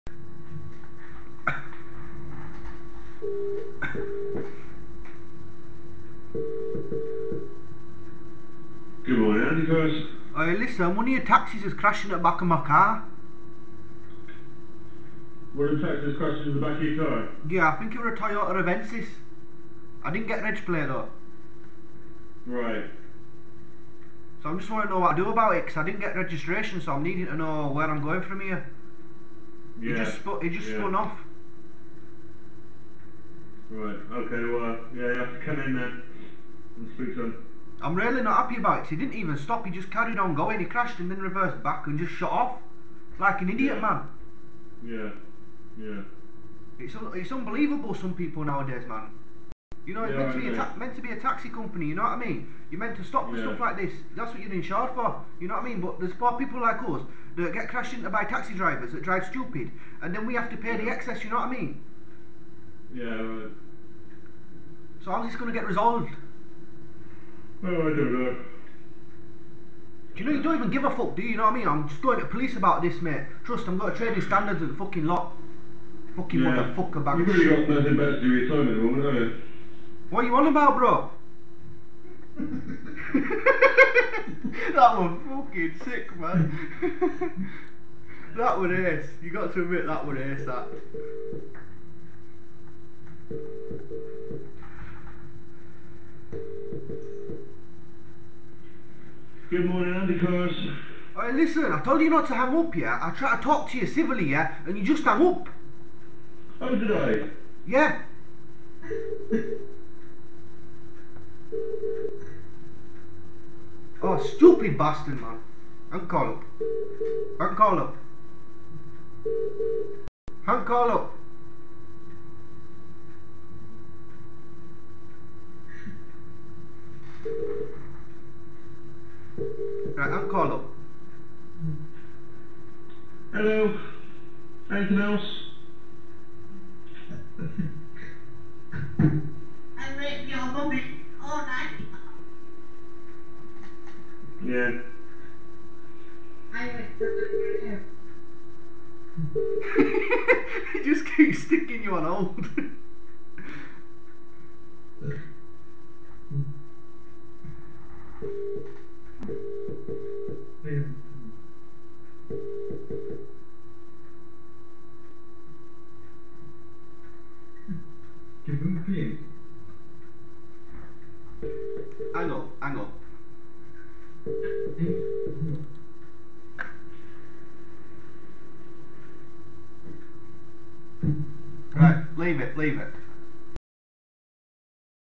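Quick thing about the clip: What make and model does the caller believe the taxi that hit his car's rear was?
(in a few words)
Toyota Avensis.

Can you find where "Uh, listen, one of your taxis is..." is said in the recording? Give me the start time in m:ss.
0:10.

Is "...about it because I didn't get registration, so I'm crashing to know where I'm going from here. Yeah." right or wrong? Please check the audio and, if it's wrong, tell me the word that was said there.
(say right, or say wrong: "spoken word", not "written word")
wrong: "needing", not "crashing".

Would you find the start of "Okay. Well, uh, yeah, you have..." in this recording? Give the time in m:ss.
0:34.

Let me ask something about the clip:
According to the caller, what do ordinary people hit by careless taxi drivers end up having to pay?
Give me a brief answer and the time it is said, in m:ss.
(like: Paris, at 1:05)
The excess, at 1:00.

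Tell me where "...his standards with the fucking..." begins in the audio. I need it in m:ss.
1:14.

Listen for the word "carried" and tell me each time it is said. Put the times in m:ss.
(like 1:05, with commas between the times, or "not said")
0:39.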